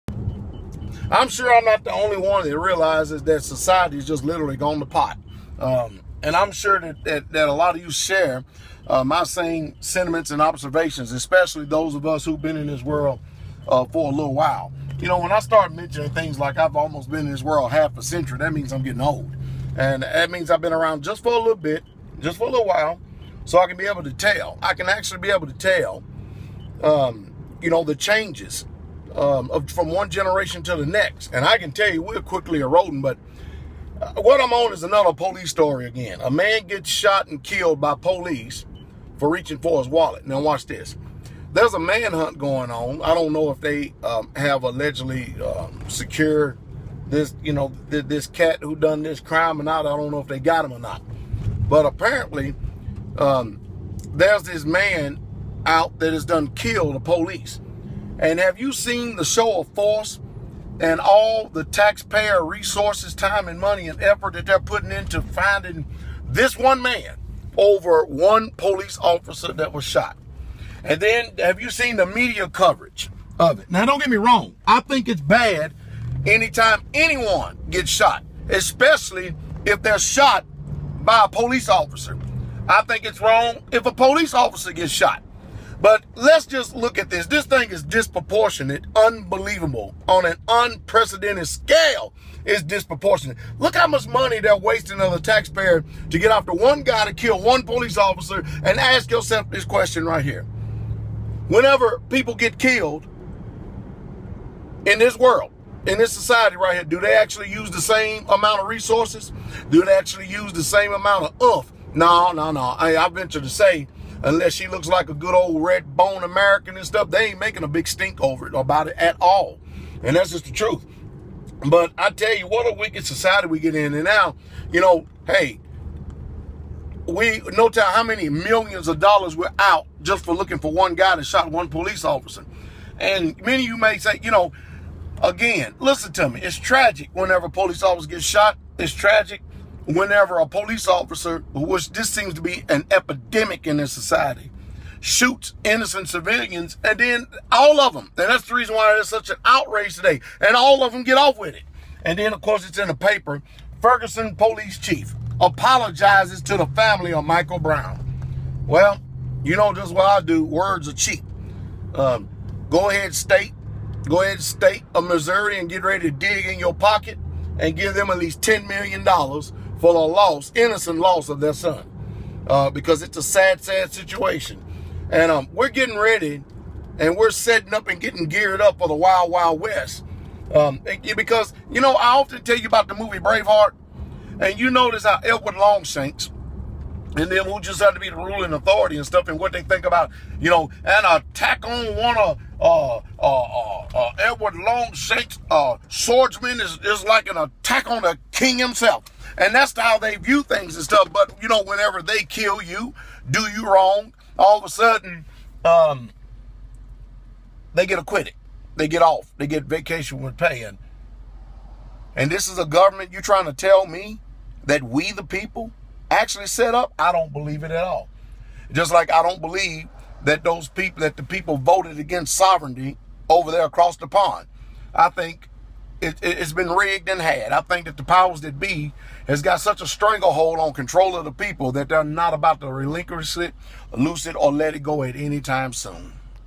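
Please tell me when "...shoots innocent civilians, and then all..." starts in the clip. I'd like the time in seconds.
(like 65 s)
144 s.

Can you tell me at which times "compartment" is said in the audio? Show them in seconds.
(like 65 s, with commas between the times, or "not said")
not said.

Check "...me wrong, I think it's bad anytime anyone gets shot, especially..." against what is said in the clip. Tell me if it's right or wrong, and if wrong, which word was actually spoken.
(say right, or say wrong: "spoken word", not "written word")
right.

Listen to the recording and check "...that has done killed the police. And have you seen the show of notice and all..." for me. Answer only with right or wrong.
wrong.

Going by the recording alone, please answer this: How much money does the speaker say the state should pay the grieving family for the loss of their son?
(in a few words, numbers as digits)
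$10 million.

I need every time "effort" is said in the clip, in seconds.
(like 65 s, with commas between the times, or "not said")
64 s.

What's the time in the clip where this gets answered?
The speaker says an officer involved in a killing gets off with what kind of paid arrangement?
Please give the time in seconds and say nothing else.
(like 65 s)
209 s.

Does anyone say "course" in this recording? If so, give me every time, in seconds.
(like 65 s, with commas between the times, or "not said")
152 s.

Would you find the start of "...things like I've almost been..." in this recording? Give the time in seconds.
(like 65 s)
16 s.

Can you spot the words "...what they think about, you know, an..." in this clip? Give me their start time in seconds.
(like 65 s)
189 s.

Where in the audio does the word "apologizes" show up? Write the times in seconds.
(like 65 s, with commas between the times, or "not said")
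155 s.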